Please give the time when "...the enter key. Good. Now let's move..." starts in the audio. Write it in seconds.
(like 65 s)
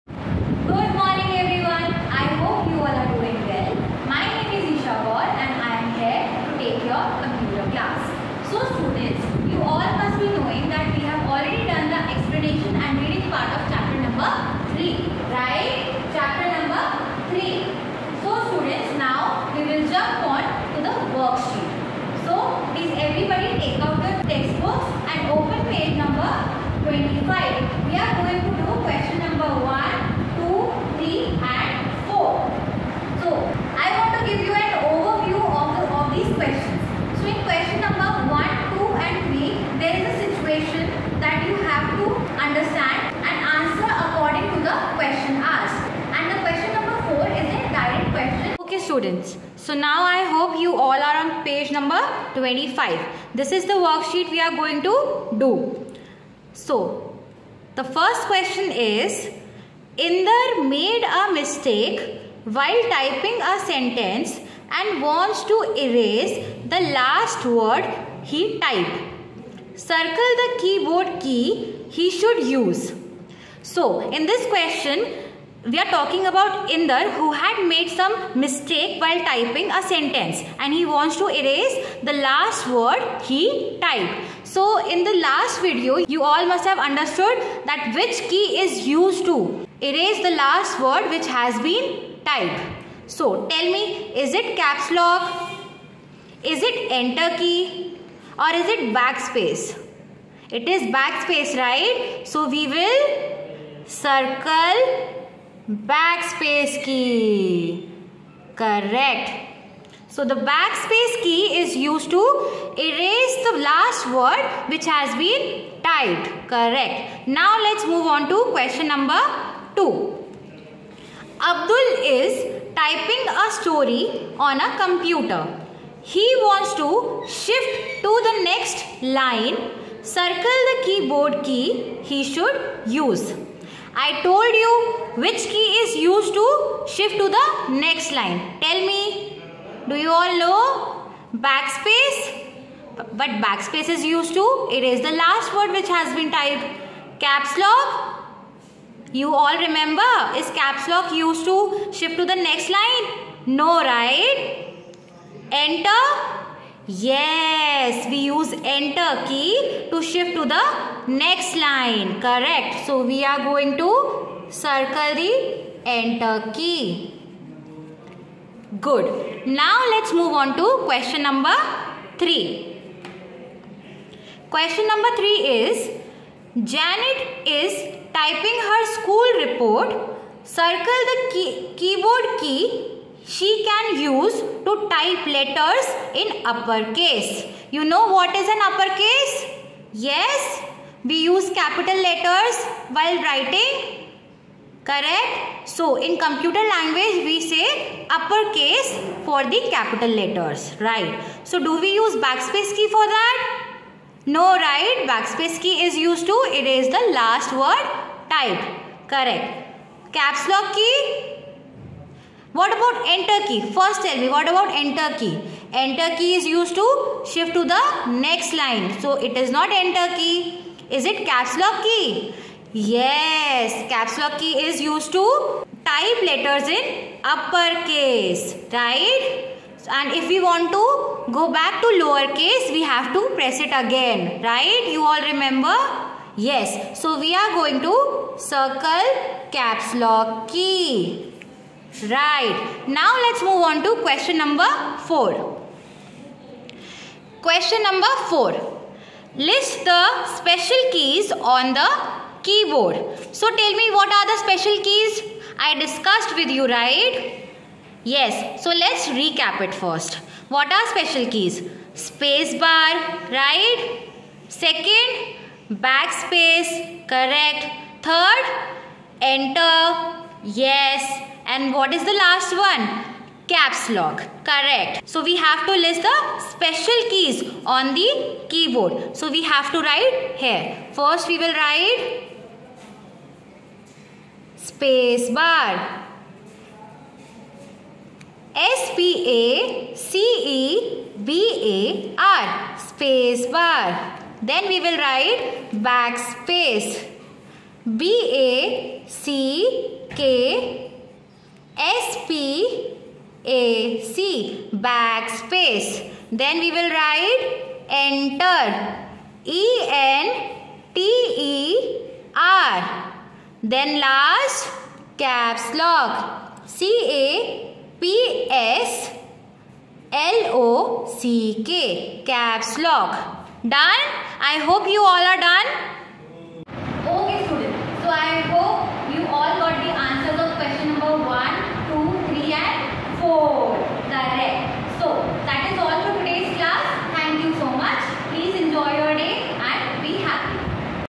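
165 s.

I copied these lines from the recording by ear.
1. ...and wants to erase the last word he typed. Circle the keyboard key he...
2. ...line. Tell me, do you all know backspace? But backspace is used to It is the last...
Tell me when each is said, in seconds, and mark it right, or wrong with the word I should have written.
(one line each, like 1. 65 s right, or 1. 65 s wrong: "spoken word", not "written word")
1. 64 s right
2. 138 s right.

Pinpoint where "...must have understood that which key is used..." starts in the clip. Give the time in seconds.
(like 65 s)
86 s.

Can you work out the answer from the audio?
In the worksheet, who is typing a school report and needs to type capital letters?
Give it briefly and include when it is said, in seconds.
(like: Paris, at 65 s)
Janet, at 176 s.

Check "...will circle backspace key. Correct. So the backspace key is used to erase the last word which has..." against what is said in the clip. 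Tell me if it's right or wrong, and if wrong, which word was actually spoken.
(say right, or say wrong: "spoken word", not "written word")
right.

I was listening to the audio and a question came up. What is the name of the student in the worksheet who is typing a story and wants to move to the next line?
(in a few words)
Abdul.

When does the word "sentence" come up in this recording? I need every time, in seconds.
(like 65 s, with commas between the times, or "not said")
63 s, 79 s.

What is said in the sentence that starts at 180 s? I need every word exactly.
Circle the key keyboard key she can use to type letters in uppercase.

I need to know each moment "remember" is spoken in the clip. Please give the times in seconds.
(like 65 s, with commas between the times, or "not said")
149 s, 235 s.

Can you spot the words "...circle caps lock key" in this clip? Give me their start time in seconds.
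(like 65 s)
238 s.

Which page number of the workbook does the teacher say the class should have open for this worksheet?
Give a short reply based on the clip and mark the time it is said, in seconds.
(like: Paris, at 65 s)
25, at 52 s.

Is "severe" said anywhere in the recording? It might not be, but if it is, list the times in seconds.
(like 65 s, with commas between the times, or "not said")
not said.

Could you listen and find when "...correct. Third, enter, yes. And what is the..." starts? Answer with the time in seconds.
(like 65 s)
267 s.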